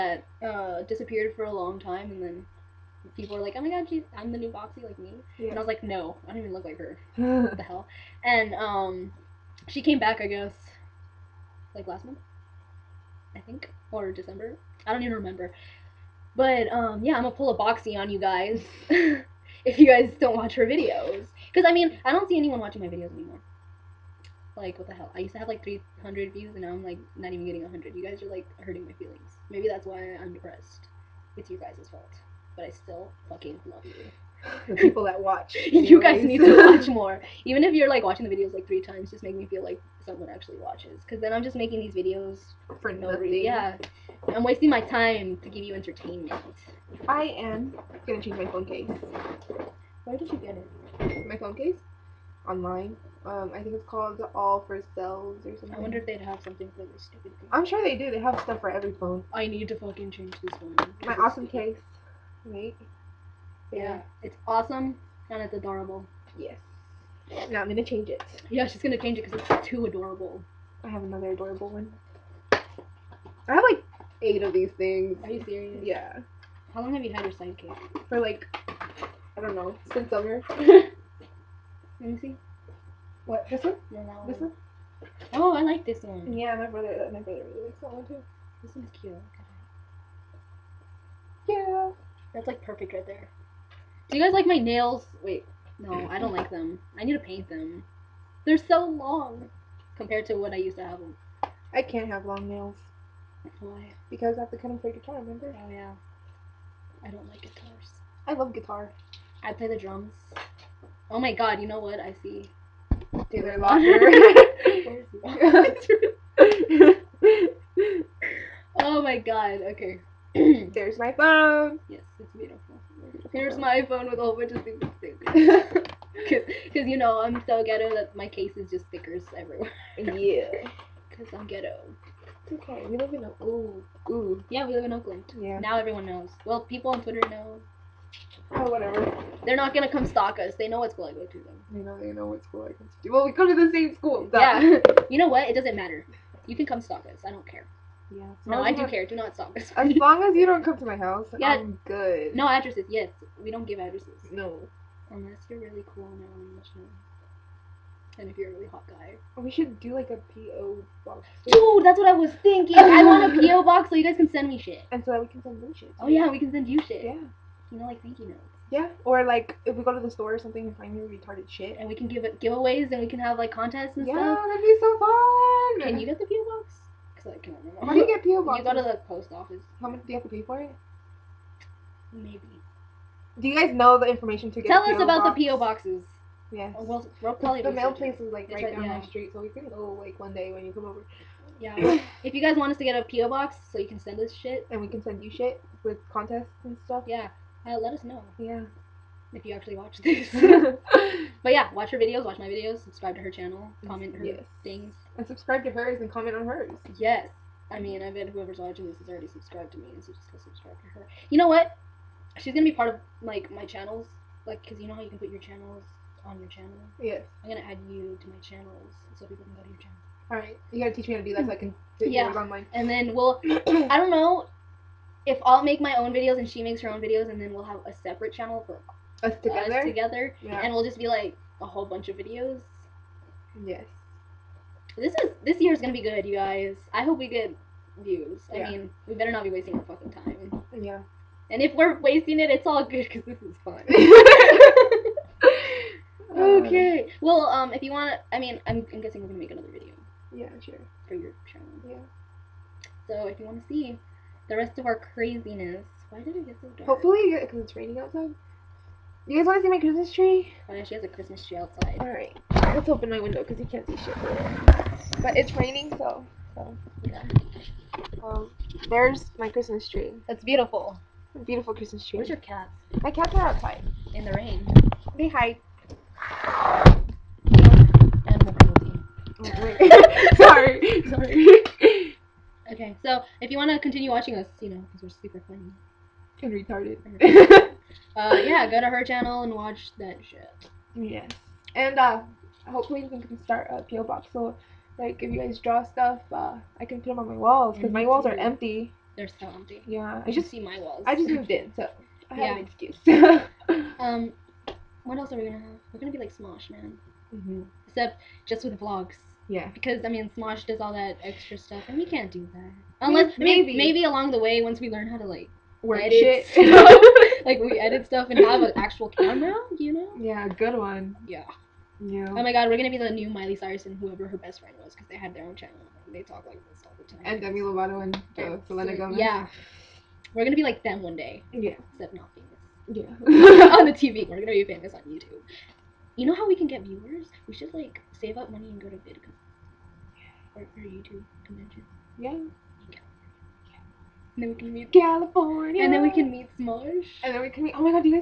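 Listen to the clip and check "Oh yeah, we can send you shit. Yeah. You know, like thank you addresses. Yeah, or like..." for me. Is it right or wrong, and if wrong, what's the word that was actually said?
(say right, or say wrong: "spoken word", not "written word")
wrong: "notes", not "addresses".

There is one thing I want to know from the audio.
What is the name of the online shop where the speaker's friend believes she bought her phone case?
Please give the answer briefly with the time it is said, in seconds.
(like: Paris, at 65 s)
All for Cells, at 54 s.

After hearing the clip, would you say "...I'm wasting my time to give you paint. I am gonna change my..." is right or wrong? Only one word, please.
wrong.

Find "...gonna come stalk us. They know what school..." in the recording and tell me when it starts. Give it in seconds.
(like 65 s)
139 s.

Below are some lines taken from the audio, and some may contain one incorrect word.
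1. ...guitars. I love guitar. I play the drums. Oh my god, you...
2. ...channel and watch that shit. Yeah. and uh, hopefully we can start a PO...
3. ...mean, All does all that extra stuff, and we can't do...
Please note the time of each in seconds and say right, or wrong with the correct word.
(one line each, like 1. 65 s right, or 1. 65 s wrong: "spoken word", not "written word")
1. 107 s right
2. 289 s right
3. 310 s wrong: "Smosh", not "All".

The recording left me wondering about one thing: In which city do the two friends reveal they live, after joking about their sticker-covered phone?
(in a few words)
Oakland.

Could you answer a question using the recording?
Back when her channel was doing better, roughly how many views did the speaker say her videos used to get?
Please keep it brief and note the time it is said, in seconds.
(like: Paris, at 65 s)
300, at 25 s.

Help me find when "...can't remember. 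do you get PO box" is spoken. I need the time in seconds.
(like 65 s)
177 s.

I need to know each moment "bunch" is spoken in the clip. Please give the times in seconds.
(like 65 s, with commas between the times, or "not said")
124 s, 231 s.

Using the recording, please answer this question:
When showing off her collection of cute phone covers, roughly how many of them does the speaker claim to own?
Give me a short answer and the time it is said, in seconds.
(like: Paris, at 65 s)
8, at 74 s.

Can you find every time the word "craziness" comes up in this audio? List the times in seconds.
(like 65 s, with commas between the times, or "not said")
255 s.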